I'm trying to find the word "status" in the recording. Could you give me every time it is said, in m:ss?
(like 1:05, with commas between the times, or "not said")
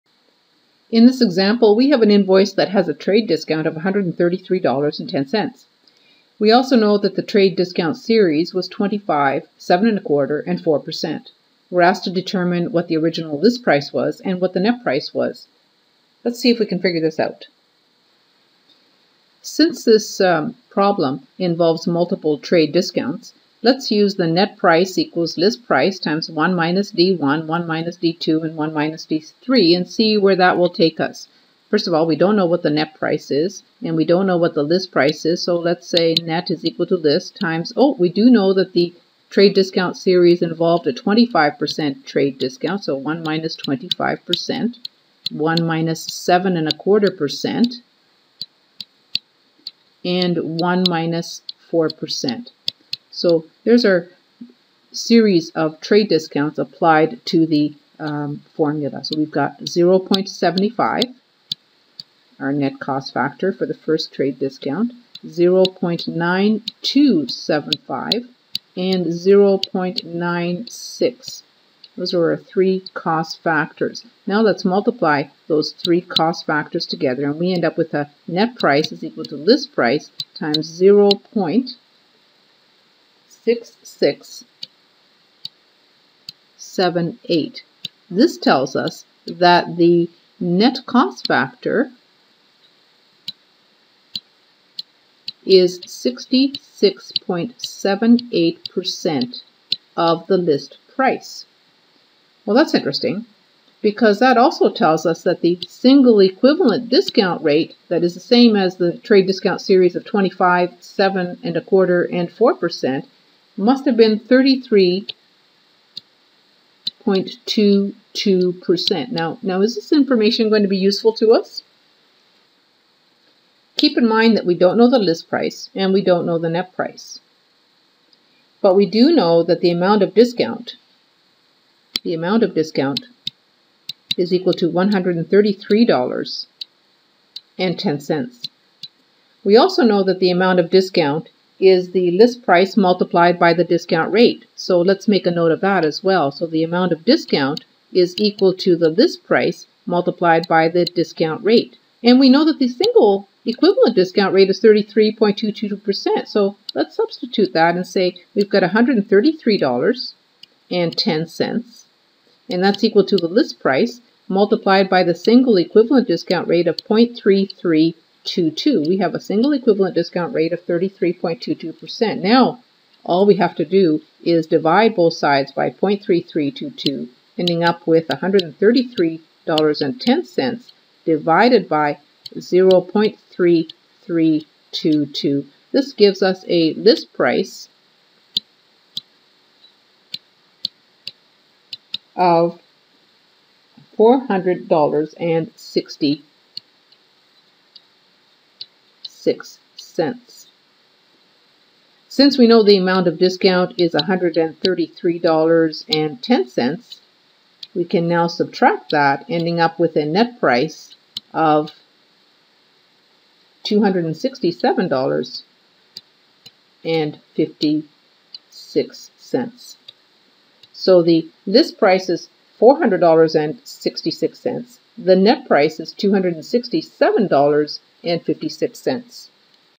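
not said.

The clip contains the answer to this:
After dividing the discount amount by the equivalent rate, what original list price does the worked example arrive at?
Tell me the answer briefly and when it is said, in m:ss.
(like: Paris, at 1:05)
$400.60, at 3:13.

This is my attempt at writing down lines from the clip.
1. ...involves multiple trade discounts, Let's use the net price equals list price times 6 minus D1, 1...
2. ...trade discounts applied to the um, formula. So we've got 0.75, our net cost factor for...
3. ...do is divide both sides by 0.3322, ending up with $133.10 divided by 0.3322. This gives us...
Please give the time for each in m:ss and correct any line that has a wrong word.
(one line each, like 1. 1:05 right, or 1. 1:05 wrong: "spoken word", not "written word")
1. 0:21 wrong: "1", not "6"
2. 0:55 right
3. 2:53 right.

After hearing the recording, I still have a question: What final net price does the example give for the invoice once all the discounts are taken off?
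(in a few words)
$267.56.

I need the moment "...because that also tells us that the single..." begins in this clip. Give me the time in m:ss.
1:43.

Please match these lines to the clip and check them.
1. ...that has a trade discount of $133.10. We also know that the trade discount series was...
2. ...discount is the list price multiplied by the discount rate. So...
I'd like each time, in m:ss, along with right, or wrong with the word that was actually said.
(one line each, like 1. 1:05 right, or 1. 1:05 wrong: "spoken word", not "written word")
1. 0:02 right
2. 2:20 right.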